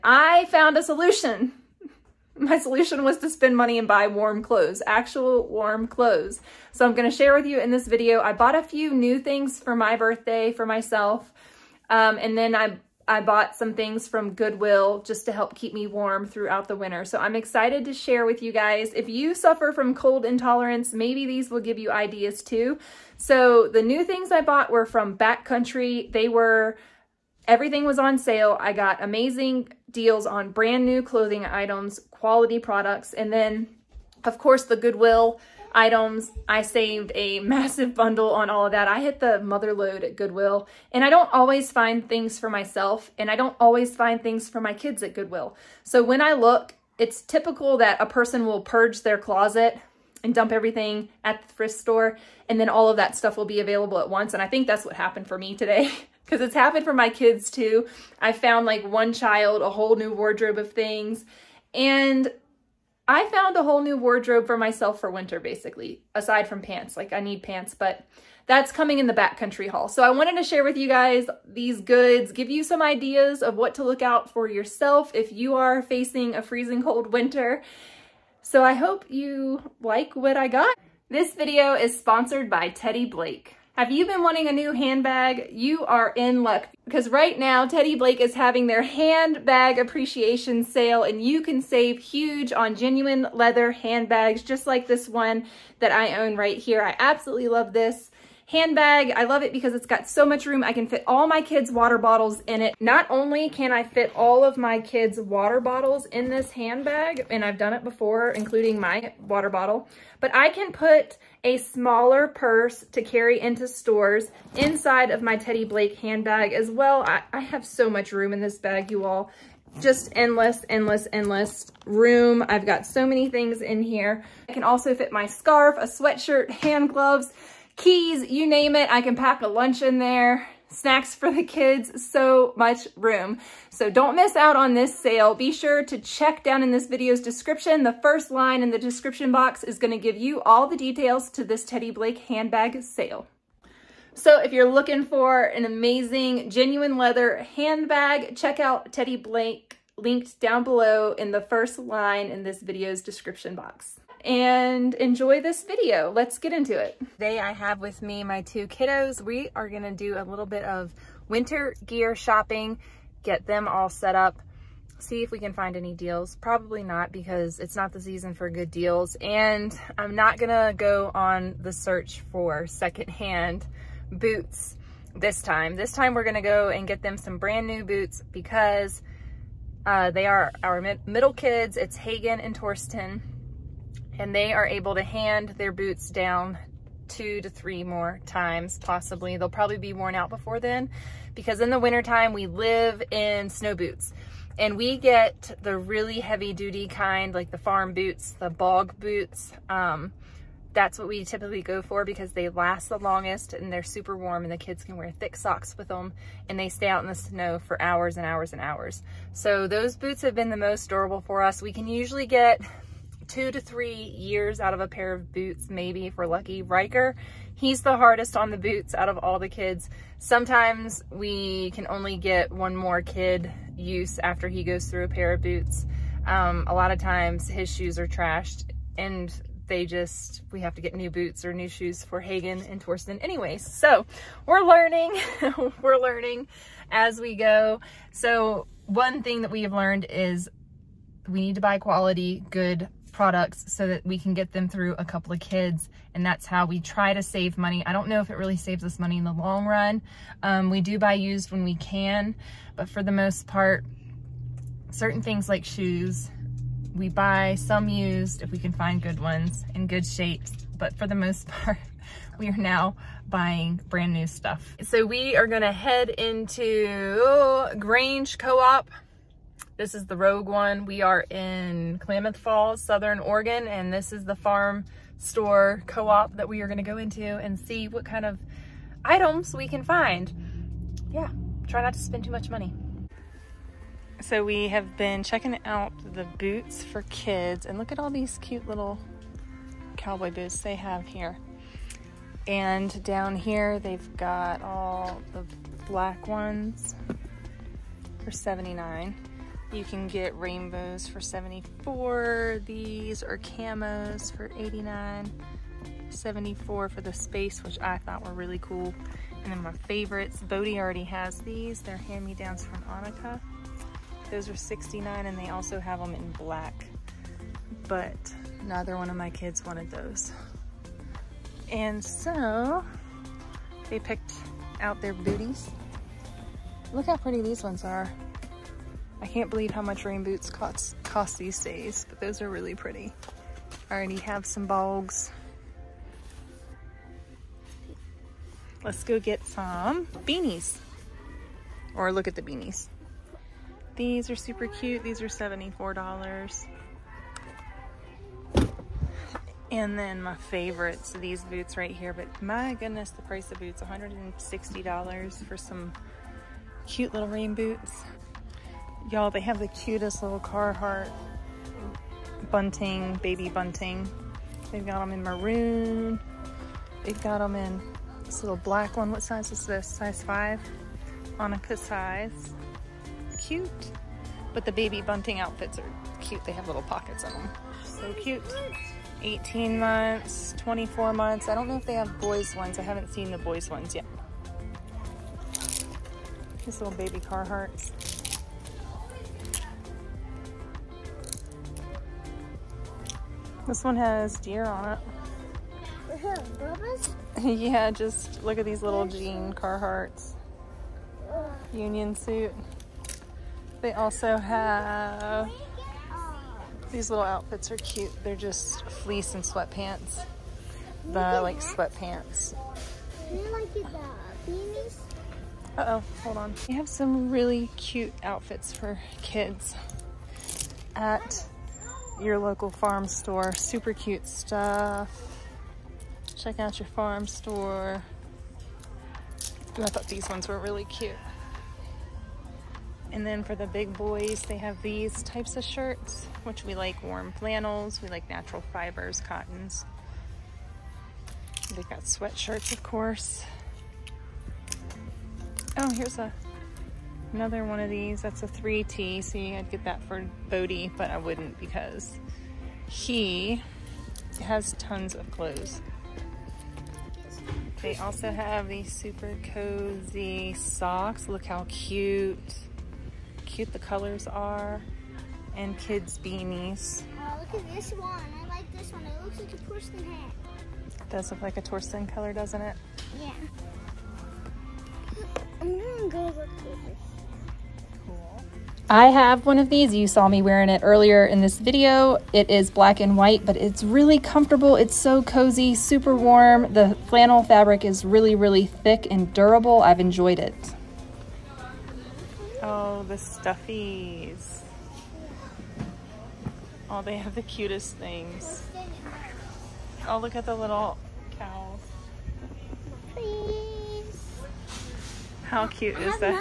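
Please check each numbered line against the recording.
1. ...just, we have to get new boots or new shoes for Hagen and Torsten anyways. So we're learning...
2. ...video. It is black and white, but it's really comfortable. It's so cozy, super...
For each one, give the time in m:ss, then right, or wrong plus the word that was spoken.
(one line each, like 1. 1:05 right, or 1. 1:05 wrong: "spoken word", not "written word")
1. 3:49 right
2. 8:01 right.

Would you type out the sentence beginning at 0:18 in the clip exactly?
If you suffer from cold intolerance, maybe these will give you ideas too.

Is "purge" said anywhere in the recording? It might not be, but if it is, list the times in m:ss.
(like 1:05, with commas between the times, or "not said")
0:48.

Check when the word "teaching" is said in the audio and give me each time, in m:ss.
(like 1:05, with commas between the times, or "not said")
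not said.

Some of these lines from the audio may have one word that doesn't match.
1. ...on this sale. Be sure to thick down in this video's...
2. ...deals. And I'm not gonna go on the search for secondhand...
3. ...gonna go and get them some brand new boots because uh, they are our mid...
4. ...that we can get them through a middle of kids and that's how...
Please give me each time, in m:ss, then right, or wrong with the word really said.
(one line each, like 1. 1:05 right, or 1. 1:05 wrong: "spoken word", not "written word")
1. 2:14 wrong: "check", not "thick"
2. 2:48 right
3. 2:56 right
4. 4:03 wrong: "couple", not "middle".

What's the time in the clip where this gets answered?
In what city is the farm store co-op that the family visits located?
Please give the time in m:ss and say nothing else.
4:31.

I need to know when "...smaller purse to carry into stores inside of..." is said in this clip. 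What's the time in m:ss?
1:51.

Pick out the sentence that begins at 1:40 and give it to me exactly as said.
I can fit all my kids' water bottles in it.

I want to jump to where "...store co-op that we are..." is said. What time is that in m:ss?
4:35.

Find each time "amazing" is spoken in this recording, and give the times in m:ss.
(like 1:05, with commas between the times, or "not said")
0:29, 2:25.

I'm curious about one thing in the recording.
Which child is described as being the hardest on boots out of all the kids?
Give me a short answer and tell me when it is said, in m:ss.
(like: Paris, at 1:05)
Riker, at 3:36.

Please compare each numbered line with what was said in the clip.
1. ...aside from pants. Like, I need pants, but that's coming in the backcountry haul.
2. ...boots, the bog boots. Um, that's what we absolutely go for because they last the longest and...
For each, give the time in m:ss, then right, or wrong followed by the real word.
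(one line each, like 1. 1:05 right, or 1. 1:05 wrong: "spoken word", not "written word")
1. 1:06 right
2. 3:17 wrong: "typically", not "absolutely".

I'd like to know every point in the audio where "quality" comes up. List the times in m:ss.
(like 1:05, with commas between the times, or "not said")
0:32, 4:01.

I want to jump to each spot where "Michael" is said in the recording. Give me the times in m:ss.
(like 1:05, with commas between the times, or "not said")
not said.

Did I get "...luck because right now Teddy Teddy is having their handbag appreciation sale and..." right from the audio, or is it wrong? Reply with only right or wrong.
wrong.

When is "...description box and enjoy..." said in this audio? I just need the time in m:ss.
2:33.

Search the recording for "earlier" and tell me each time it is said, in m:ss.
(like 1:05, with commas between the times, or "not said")
8:00.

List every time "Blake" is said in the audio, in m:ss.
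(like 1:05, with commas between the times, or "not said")
1:23, 1:27, 1:55, 2:21, 2:29.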